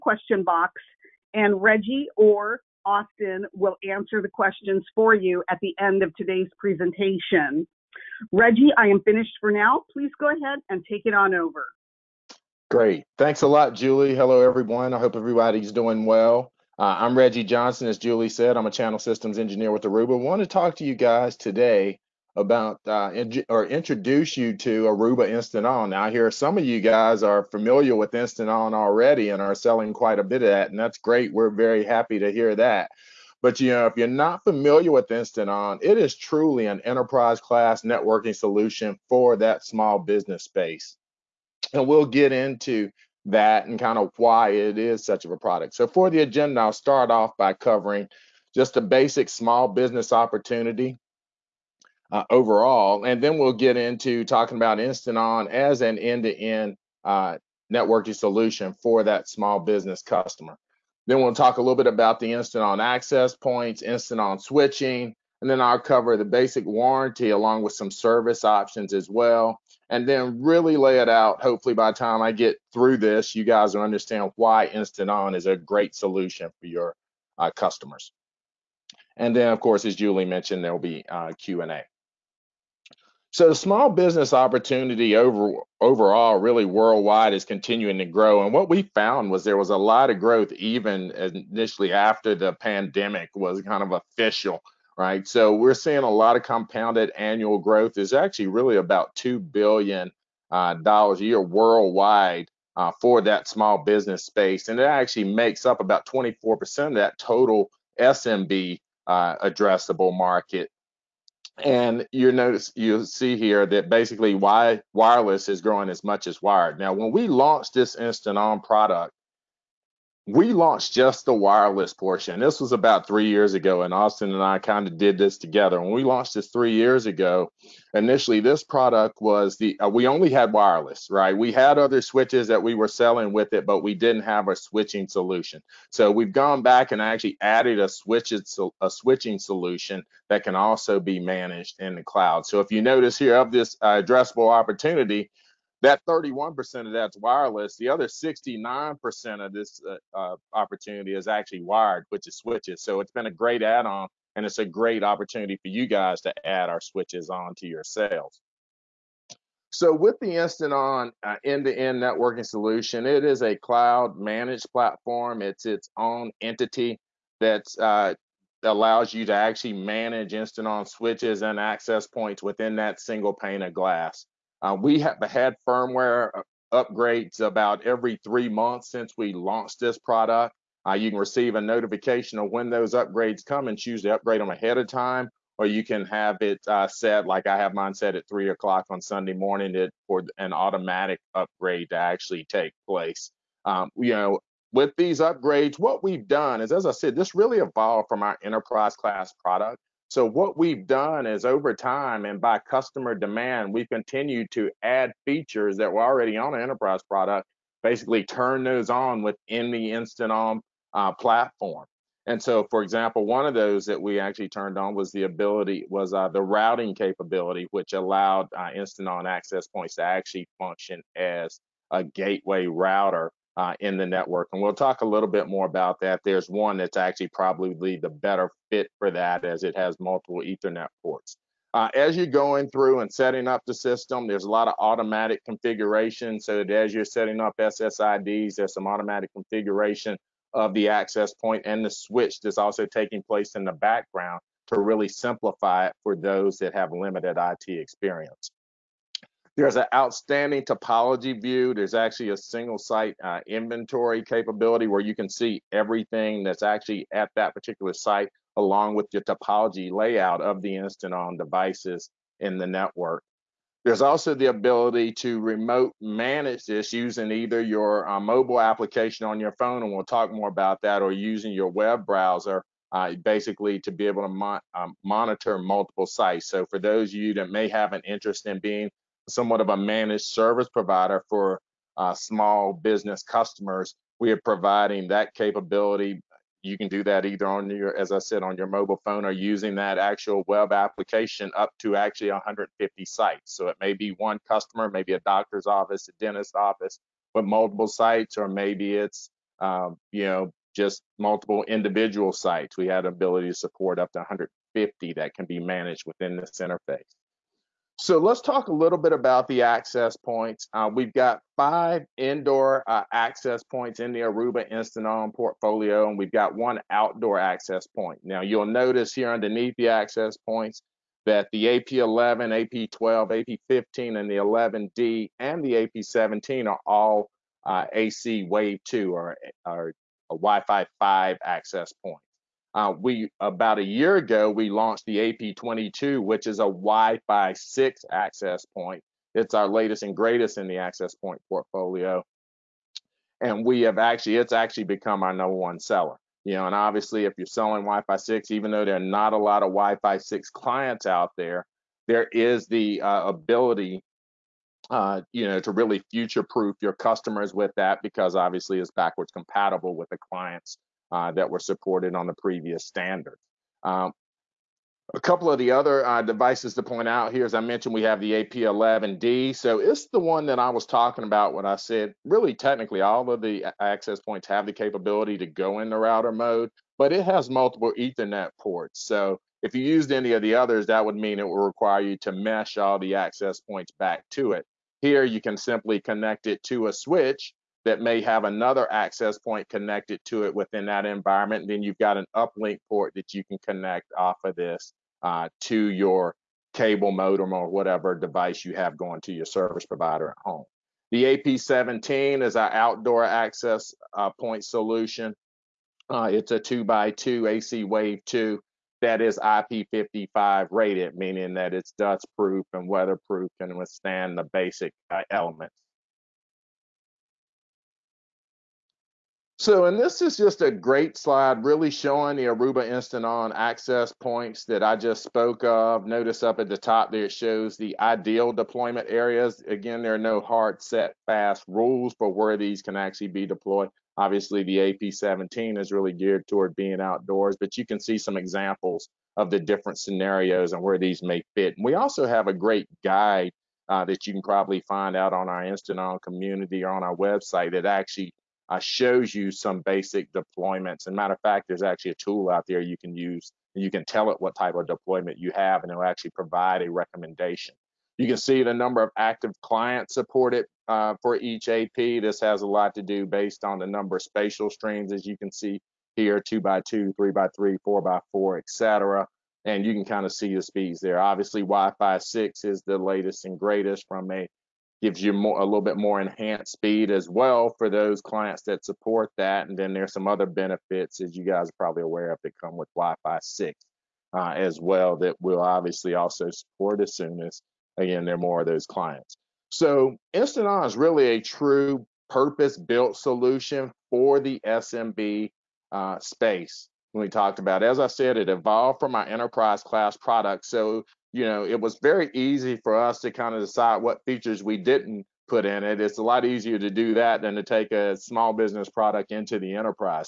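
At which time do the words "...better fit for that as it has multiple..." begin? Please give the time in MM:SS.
03:48.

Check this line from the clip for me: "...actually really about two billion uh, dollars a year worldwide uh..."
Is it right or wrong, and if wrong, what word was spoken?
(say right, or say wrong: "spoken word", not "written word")
right.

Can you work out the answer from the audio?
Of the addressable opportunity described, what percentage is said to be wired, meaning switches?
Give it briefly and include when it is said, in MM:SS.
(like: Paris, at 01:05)
69%, at 02:28.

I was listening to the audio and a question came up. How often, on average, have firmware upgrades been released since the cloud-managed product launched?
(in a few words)
Every three months.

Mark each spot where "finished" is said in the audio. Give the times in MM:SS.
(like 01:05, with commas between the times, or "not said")
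00:09.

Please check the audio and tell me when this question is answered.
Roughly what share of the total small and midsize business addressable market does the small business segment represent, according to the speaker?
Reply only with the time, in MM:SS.
01:46.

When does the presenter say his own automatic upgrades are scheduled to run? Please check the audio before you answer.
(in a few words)
3 o'clock Sunday morning.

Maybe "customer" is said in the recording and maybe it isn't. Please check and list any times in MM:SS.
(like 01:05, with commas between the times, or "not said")
01:00, 01:17, 03:22, 04:43, 04:54, 05:56.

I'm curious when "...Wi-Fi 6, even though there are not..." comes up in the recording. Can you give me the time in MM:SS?
05:47.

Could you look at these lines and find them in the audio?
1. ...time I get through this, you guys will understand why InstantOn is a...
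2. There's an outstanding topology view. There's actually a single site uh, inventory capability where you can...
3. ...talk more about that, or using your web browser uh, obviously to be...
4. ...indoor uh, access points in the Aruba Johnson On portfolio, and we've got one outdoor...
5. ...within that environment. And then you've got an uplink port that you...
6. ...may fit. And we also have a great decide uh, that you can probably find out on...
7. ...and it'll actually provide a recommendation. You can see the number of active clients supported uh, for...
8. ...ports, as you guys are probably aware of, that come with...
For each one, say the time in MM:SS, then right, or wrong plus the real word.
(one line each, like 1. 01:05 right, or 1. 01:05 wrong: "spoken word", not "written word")
1. 01:11 right
2. 04:09 right
3. 04:30 wrong: "basically", not "obviously"
4. 05:12 wrong: "Instant", not "Johnson"
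5. 06:30 right
6. 07:21 wrong: "guide", not "decide"
7. 07:35 right
8. 08:00 wrong: "benefits", not "ports".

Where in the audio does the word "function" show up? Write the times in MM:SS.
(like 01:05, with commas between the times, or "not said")
03:40.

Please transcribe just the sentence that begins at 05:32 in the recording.
Uh, we about a year ago we launched the AP22, which is a Wi-Fi 6 access point.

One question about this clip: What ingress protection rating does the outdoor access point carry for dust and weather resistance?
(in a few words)
IP55.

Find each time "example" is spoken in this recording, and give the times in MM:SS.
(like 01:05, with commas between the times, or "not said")
03:32, 07:18.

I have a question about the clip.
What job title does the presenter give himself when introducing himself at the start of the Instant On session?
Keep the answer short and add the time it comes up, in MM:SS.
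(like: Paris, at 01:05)
Channel systems engineer, at 00:18.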